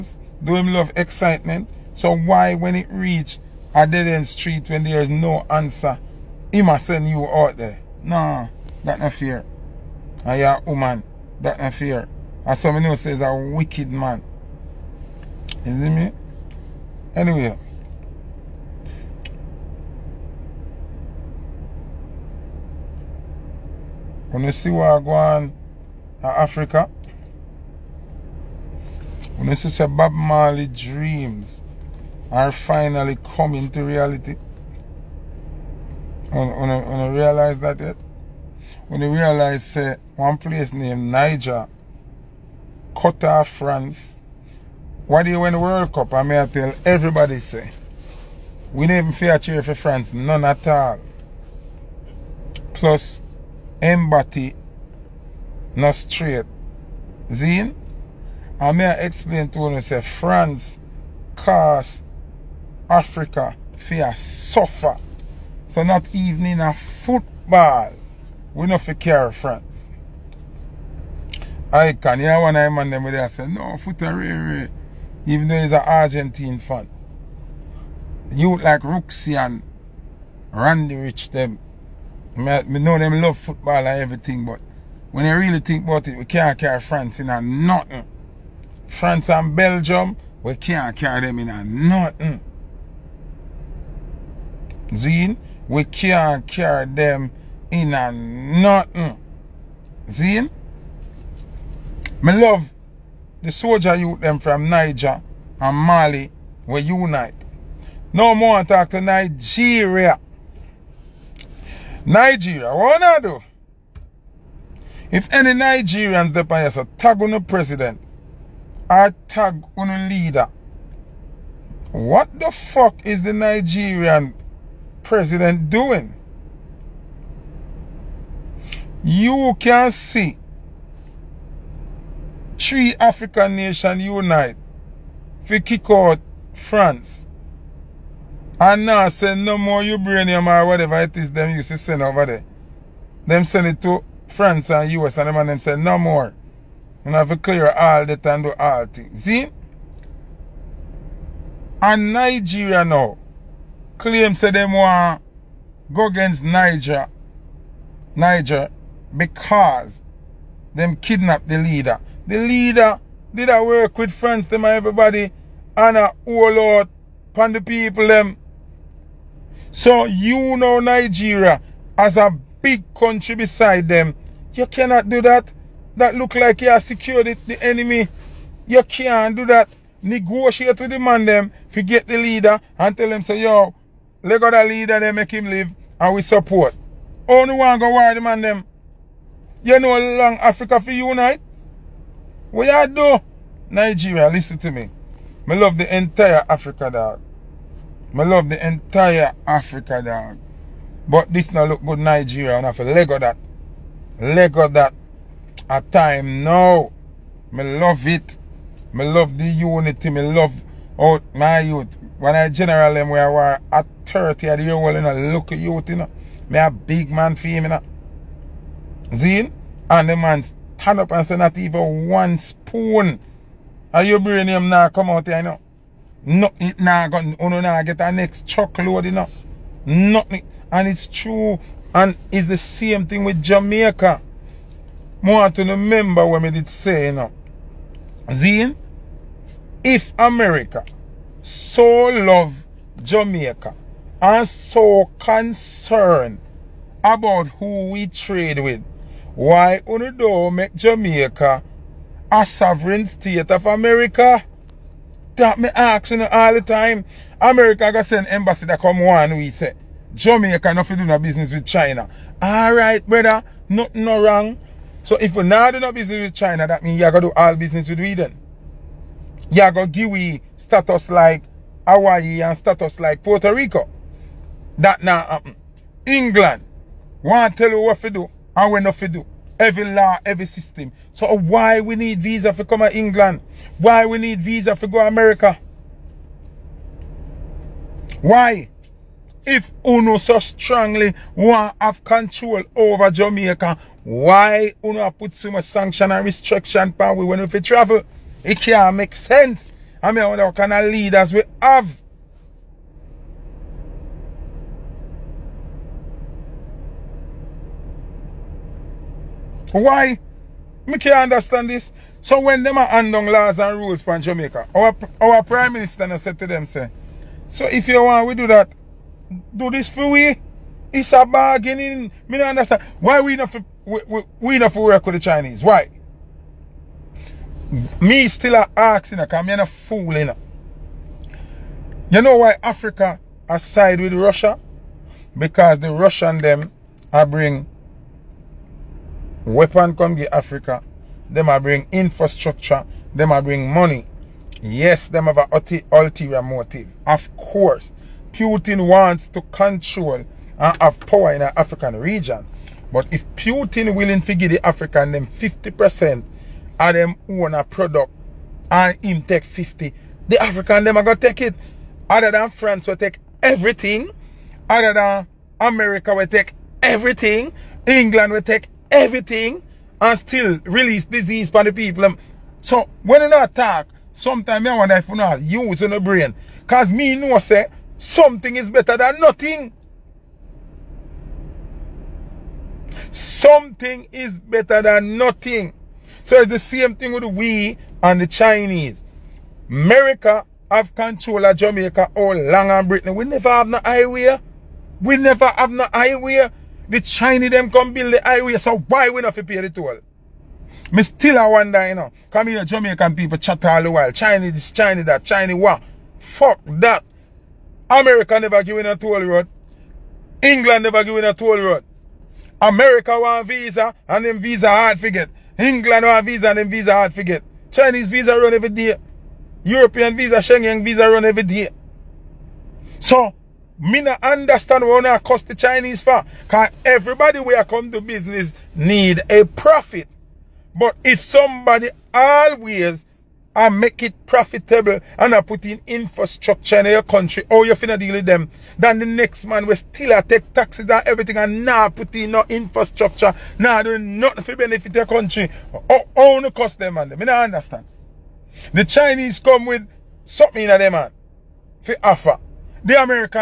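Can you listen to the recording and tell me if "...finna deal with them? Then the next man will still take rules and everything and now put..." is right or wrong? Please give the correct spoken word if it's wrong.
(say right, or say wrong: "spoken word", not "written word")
wrong: "taxes", not "rules".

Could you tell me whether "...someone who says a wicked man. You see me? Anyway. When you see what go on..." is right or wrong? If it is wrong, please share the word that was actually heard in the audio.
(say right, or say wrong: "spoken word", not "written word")
right.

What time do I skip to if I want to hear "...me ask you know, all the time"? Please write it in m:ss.
4:15.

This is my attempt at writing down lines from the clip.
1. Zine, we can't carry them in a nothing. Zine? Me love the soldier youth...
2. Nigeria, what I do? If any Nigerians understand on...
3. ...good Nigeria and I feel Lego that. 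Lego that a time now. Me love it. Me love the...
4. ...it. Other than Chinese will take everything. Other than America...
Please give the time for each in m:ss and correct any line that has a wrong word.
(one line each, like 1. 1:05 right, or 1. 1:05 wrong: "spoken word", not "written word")
1. 1:34 right
2. 1:52 wrong: "depend", not "understand"
3. 3:21 right
4. 6:01 wrong: "France", not "Chinese".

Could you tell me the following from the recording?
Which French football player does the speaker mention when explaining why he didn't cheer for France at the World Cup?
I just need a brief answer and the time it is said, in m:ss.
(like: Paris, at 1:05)
Mbappe, at 0:53.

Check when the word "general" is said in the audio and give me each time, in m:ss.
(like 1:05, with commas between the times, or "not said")
3:32.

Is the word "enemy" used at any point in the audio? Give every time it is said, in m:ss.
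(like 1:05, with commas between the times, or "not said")
2:57.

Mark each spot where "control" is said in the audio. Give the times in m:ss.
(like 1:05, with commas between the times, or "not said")
4:52, 5:49, 6:30.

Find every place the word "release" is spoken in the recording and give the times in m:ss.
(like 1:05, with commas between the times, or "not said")
6:10.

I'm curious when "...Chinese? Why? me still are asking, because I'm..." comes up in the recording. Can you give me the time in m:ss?
5:25.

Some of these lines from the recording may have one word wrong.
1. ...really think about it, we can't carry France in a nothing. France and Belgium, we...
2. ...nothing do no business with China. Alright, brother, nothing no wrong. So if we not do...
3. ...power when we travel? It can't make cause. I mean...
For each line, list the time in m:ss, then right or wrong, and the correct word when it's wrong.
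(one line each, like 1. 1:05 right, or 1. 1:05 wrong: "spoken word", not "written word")
1. 1:25 right
2. 4:20 right
3. 4:56 wrong: "sense", not "cause".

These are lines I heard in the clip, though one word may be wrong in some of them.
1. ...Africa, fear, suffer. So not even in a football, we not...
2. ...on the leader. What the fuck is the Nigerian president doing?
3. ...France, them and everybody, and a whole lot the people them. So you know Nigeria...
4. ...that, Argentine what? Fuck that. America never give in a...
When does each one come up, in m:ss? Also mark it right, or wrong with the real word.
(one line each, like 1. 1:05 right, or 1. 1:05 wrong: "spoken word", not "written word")
1. 1:02 right
2. 1:59 right
3. 2:44 right
4. 6:45 wrong: "Chinese", not "Argentine".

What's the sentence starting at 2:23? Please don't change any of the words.
Them send it to France and US and them and them say no more.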